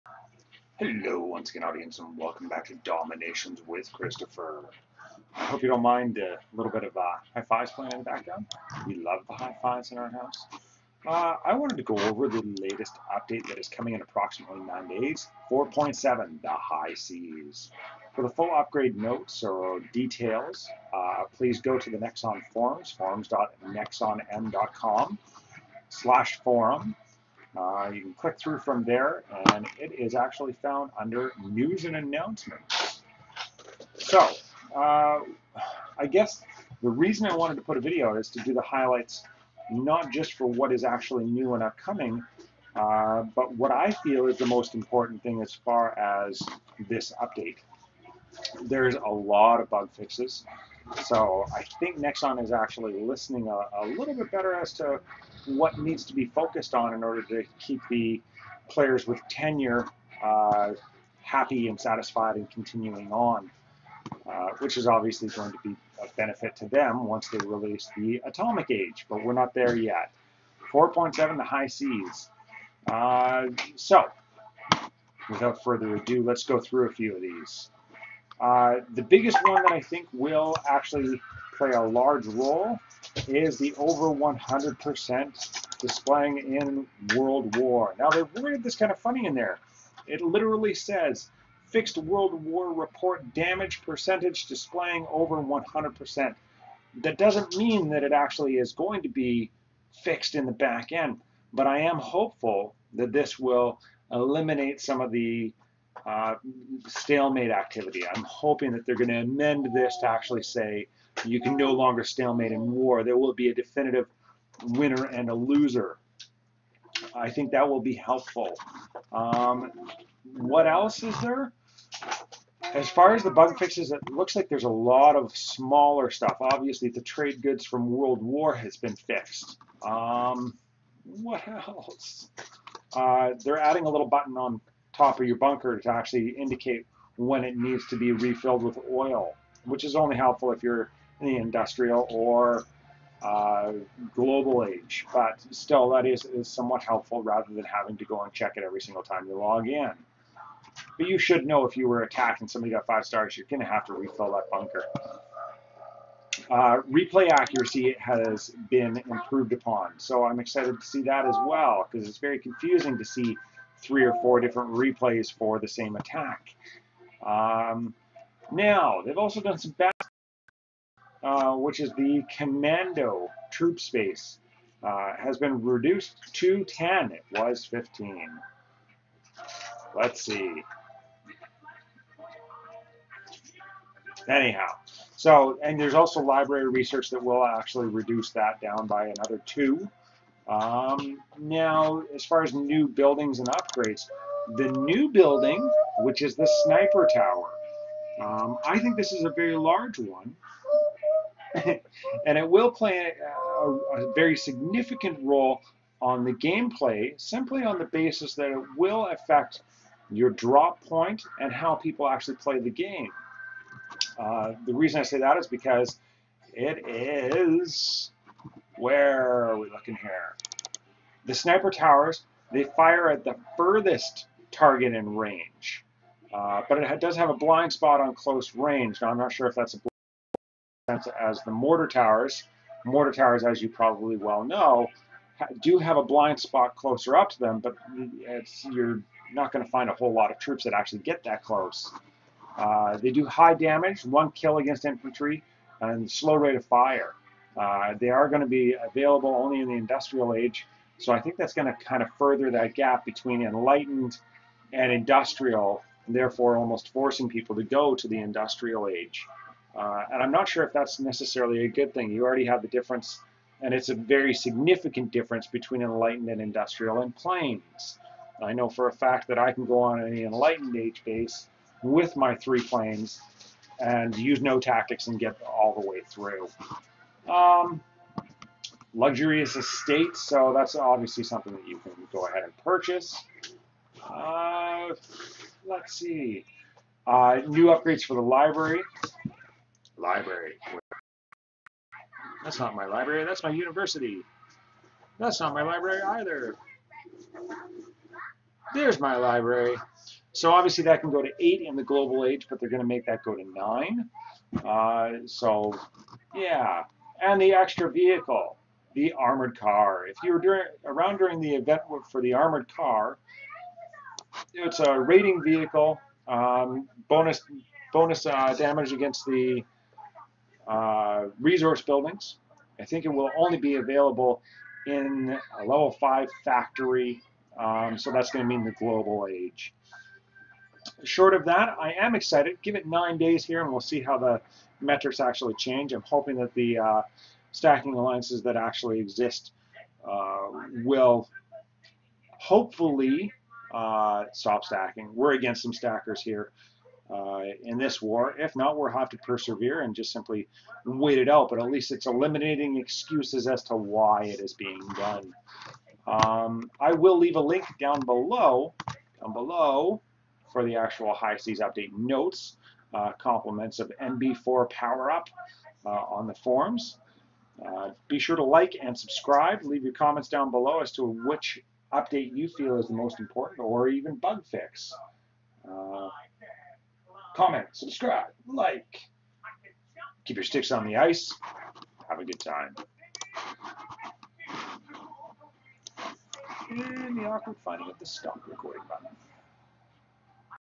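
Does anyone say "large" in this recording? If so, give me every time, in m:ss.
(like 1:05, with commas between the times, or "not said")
1:21, 3:19.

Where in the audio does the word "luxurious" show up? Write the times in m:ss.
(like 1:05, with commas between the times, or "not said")
4:38.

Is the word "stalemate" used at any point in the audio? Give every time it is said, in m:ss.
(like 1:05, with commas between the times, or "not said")
1:46, 1:52.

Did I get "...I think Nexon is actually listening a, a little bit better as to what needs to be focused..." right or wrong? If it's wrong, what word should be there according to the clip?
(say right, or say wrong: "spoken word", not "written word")
right.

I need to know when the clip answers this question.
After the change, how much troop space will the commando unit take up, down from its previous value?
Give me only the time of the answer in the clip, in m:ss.
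2:56.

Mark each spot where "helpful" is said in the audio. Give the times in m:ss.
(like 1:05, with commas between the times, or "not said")
1:57, 2:20, 2:26.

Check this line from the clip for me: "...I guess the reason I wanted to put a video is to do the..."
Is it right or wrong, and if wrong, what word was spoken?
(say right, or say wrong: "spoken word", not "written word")
right.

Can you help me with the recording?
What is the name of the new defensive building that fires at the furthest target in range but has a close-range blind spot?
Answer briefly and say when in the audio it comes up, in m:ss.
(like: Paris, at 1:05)
Sniper Tower, at 3:16.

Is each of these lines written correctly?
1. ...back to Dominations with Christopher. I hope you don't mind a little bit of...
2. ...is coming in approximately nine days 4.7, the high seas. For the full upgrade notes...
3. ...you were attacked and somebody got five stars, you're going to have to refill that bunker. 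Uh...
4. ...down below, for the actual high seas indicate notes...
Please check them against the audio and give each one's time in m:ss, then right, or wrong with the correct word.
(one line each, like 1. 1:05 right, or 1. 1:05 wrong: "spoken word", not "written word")
1. 0:02 right
2. 0:13 right
3. 2:31 right
4. 5:59 wrong: "update", not "indicate".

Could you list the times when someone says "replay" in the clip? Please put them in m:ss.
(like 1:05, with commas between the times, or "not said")
2:36, 2:44.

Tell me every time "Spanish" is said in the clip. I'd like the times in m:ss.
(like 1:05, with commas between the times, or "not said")
not said.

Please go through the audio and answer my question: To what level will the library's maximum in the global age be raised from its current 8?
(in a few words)
9.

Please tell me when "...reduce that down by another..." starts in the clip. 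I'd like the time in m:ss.
3:07.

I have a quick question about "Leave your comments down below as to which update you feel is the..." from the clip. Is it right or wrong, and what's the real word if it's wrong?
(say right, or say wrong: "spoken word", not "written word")
right.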